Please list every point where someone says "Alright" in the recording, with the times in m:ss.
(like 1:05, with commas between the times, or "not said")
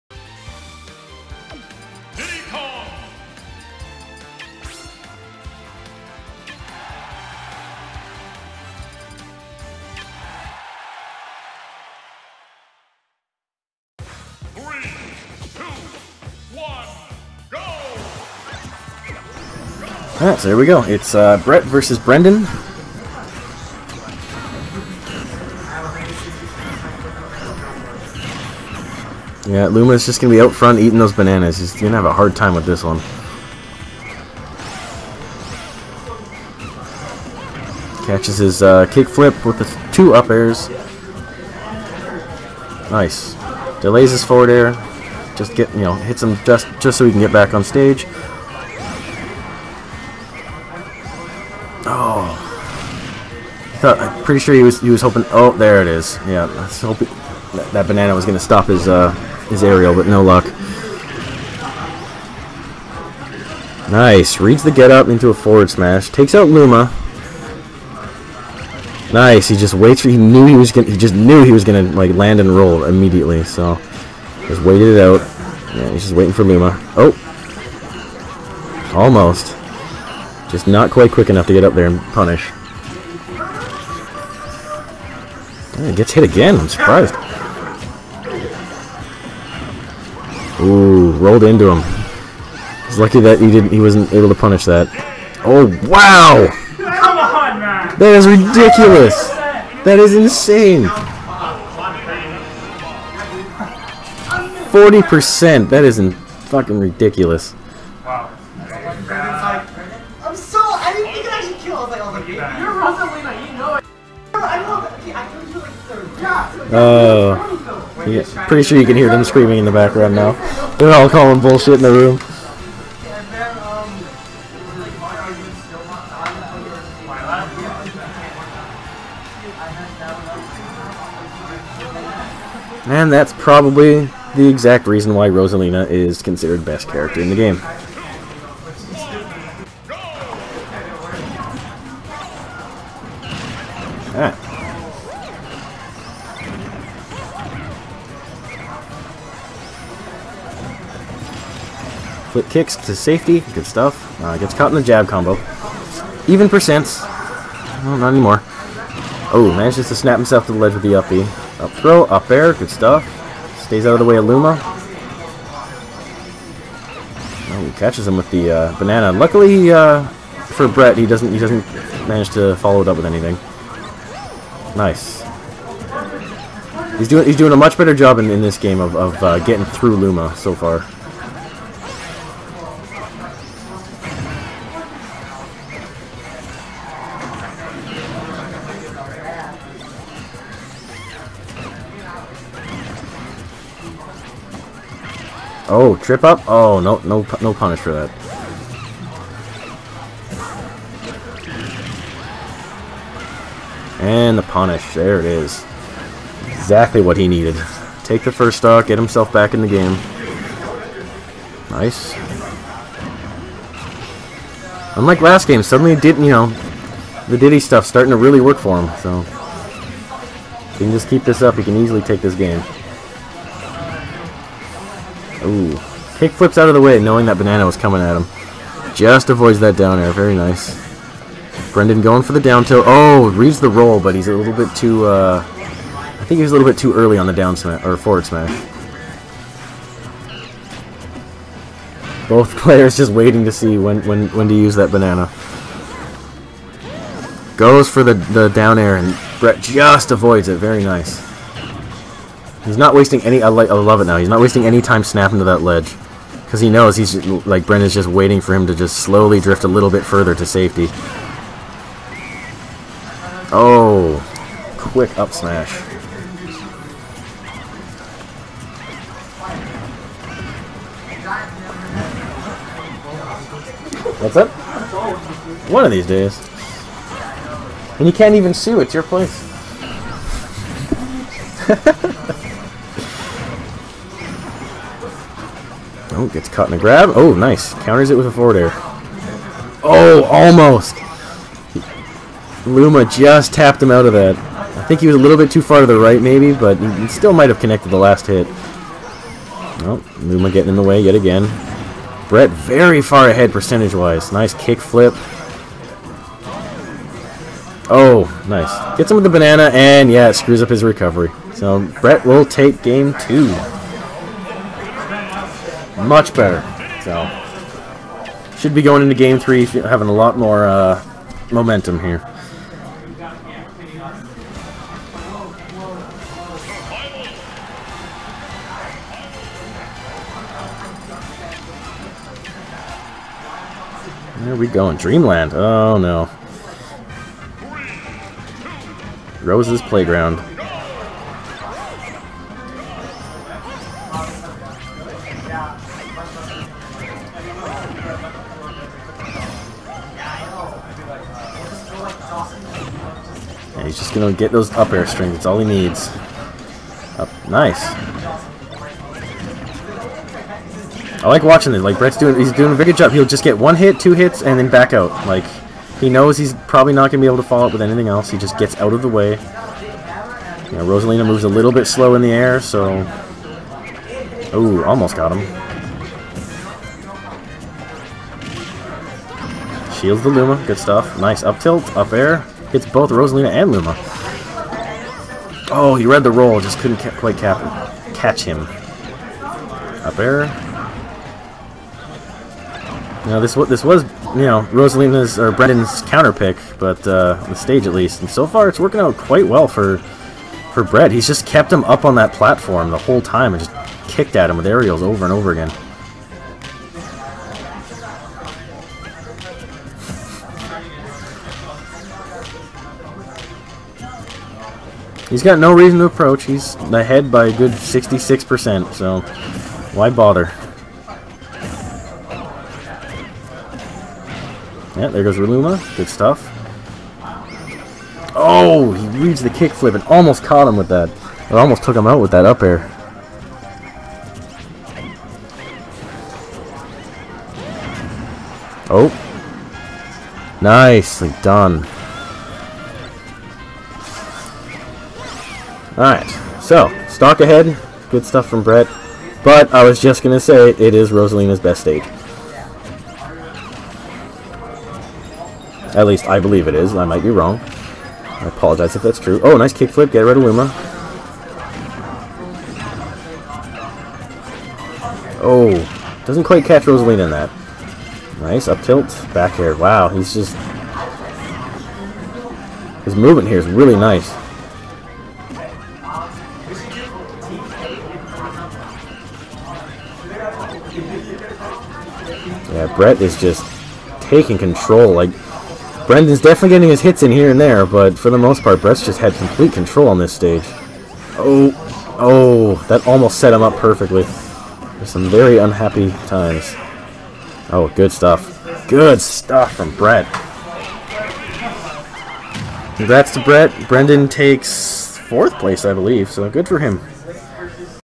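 0:20, 7:25.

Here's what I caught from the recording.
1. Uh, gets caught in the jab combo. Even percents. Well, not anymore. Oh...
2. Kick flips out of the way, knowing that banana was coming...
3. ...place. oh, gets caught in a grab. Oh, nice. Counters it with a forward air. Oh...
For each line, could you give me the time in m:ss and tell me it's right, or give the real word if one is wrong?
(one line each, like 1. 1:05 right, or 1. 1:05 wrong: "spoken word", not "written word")
1. 2:34 right
2. 3:46 right
3. 4:39 right.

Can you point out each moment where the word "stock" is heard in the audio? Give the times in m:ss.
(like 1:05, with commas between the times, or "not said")
3:28, 7:27.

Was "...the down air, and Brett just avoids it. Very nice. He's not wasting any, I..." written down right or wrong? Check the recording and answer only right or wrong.
right.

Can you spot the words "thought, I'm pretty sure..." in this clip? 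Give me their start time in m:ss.
0:53.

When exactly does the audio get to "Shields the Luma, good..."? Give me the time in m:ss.
6:19.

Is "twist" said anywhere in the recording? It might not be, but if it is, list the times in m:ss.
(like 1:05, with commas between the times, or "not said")
not said.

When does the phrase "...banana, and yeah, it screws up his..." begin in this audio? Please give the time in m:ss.
5:09.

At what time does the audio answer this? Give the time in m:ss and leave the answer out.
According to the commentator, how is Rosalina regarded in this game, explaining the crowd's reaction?
2:16.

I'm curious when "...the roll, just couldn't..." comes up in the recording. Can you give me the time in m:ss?
6:26.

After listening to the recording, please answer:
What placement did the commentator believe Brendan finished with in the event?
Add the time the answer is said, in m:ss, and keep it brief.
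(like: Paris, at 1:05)
fourth place, at 8:25.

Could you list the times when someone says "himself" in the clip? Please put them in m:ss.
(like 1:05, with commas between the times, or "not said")
2:40, 3:28.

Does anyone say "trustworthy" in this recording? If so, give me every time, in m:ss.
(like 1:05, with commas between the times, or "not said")
not said.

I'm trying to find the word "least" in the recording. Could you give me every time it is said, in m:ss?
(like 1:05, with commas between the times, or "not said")
6:37, 7:36.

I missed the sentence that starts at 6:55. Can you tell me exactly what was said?
He's got no reason to approach.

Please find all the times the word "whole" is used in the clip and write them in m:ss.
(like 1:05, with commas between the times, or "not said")
6:42.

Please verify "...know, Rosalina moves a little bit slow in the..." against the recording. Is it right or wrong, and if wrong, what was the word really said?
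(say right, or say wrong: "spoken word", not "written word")
right.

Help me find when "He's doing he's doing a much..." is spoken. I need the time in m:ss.
2:56.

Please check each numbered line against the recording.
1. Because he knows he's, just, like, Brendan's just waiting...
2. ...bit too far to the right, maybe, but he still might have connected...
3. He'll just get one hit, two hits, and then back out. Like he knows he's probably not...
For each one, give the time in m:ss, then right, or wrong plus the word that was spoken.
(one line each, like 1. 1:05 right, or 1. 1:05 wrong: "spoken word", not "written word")
1. 4:16 right
2. 4:55 right
3. 6:03 right.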